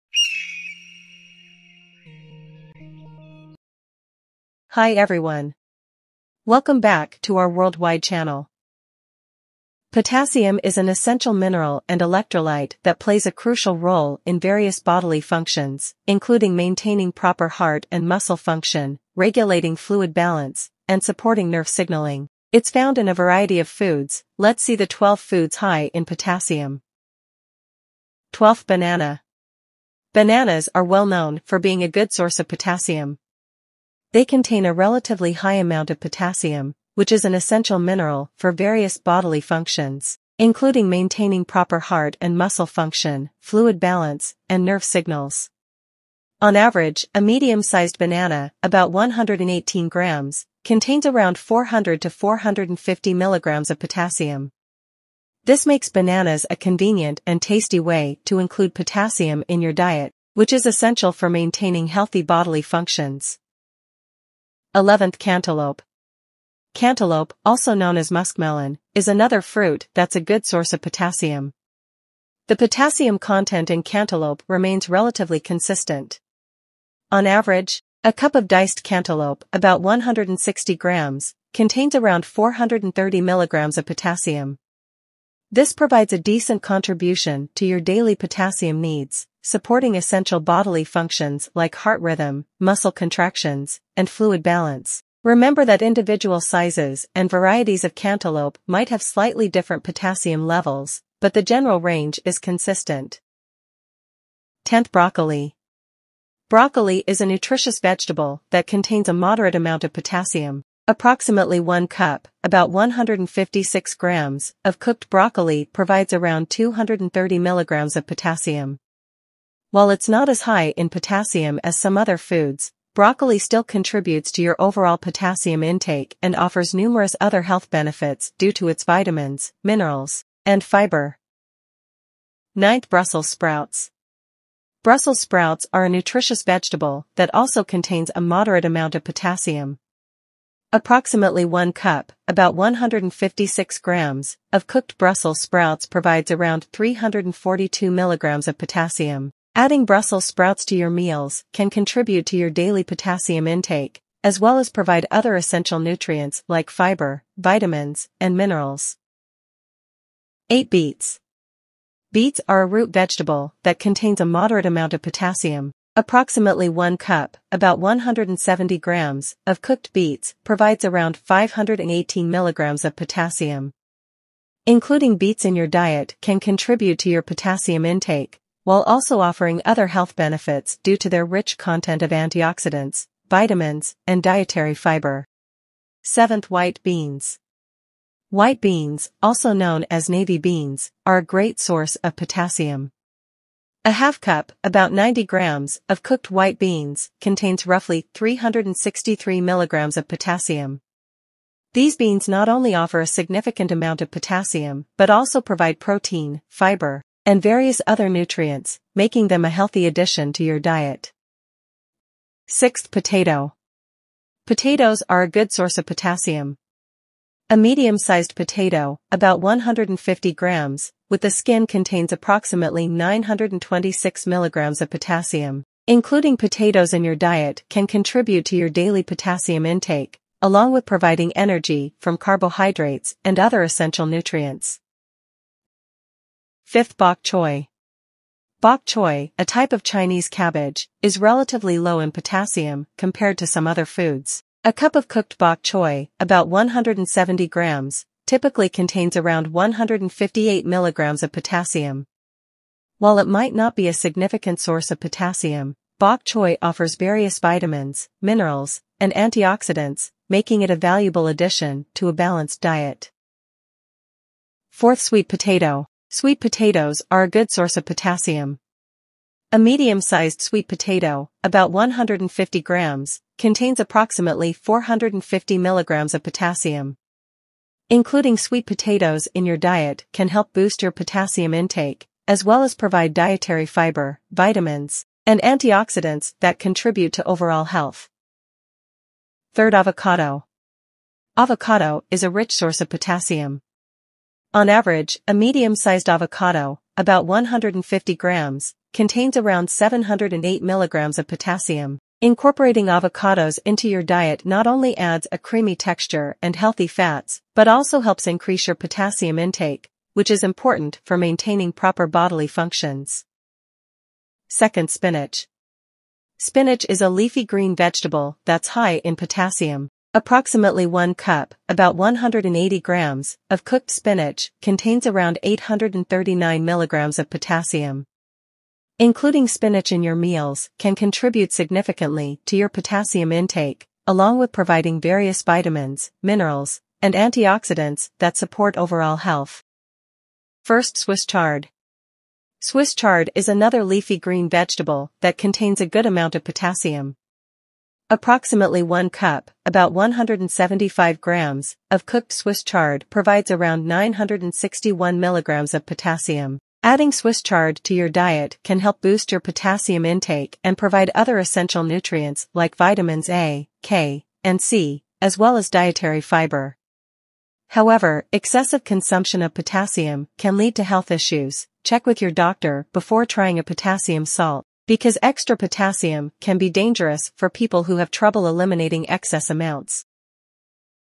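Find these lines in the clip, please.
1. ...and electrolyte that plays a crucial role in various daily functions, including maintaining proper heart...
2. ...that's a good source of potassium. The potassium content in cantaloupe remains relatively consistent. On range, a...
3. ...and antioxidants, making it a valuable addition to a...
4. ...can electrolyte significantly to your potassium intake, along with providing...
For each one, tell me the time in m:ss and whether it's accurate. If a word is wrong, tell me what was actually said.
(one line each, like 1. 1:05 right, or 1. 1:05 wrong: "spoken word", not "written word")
1. 0:11 wrong: "bodily", not "daily"
2. 1:09 wrong: "average", not "range"
3. 4:18 right
4. 5:30 wrong: "contribute", not "electrolyte".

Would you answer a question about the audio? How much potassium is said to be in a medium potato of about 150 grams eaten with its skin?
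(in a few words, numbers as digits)
926 milligrams.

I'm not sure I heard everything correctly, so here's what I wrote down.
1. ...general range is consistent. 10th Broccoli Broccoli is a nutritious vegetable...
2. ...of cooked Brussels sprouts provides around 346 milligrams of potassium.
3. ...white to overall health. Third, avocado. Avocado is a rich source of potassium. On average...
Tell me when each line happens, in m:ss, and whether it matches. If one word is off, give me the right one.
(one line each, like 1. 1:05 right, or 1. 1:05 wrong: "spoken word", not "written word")
1. 1:41 right
2. 2:24 wrong: "342", not "346"
3. 4:46 wrong: "contribute", not "white".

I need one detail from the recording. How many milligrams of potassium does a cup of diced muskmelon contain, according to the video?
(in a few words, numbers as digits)
430 milligrams.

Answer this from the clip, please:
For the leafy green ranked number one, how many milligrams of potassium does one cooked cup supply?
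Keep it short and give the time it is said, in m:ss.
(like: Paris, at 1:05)
961 milligrams, at 5:53.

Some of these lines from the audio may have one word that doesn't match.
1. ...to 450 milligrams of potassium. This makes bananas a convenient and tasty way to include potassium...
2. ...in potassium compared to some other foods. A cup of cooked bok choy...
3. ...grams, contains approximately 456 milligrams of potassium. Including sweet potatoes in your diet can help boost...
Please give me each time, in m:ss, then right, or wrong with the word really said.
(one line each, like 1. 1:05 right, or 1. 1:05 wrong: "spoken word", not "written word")
1. 0:52 right
2. 4:01 right
3. 4:32 wrong: "450", not "456".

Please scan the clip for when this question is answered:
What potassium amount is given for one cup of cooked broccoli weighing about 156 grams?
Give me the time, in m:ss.
1:56.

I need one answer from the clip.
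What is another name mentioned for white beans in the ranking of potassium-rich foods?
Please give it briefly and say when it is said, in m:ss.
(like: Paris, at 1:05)
navy beans, at 3:10.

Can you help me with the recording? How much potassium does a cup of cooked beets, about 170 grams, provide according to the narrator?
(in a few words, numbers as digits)
518 milligrams.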